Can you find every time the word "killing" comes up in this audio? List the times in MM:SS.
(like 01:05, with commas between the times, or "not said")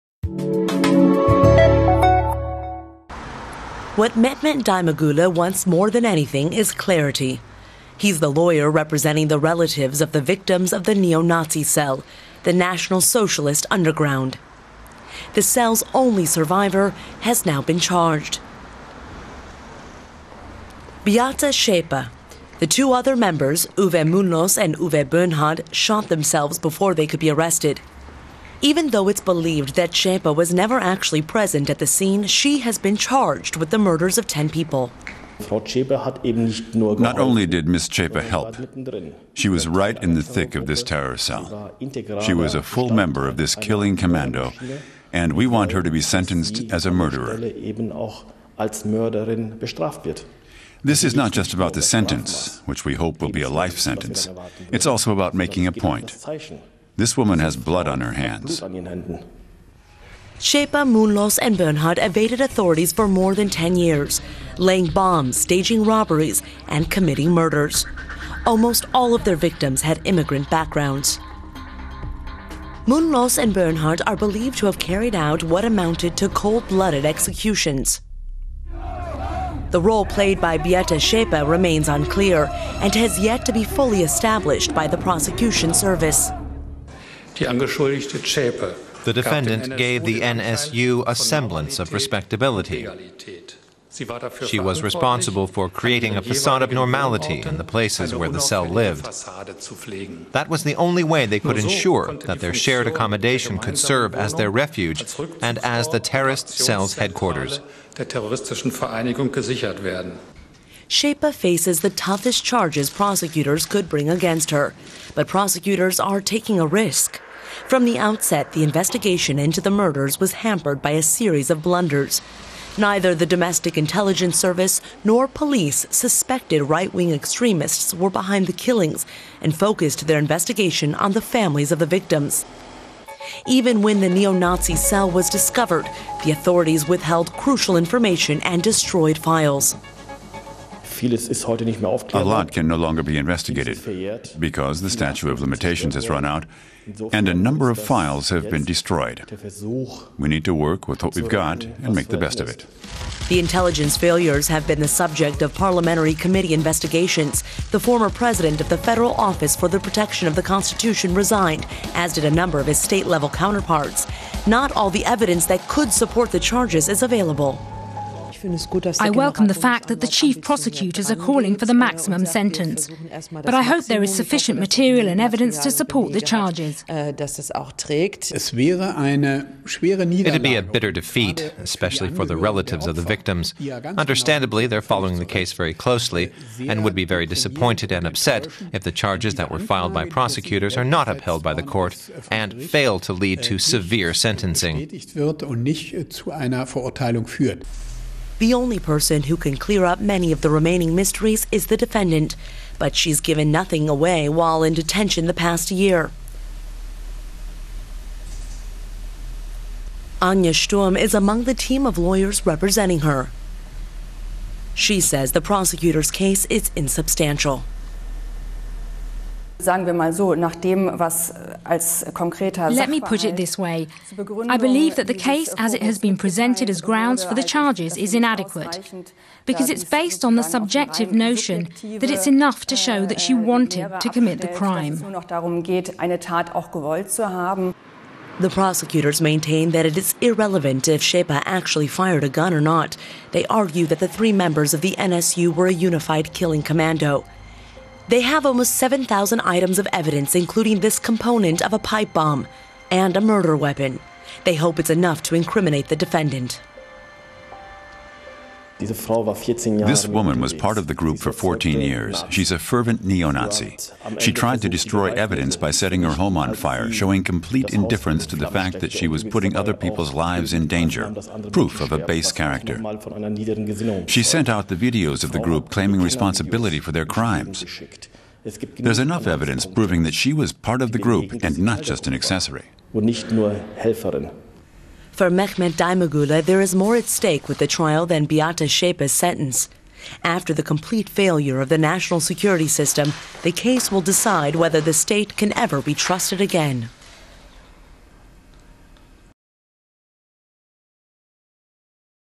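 00:43, 02:08, 04:06.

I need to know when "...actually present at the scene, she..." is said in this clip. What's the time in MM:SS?
00:30.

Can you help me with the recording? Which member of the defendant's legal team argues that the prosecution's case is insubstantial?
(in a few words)
Anja Sturm.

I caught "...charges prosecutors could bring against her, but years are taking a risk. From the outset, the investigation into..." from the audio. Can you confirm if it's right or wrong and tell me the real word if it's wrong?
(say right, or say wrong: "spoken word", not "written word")
wrong: "prosecutors", not "years".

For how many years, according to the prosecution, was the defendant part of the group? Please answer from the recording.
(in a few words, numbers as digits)
14.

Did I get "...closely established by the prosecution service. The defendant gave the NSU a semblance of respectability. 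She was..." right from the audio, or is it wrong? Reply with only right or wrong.
wrong.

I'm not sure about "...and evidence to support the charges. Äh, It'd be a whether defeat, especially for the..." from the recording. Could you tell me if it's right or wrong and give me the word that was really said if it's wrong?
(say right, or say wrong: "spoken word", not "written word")
wrong: "bitter", not "whether".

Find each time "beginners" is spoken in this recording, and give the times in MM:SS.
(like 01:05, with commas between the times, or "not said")
not said.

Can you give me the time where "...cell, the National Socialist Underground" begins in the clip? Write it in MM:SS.
00:11.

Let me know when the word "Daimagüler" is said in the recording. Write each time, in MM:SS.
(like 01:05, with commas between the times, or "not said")
00:04, 04:45.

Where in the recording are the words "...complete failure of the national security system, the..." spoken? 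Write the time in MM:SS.
04:50.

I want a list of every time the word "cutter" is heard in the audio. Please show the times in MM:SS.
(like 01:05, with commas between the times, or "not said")
not said.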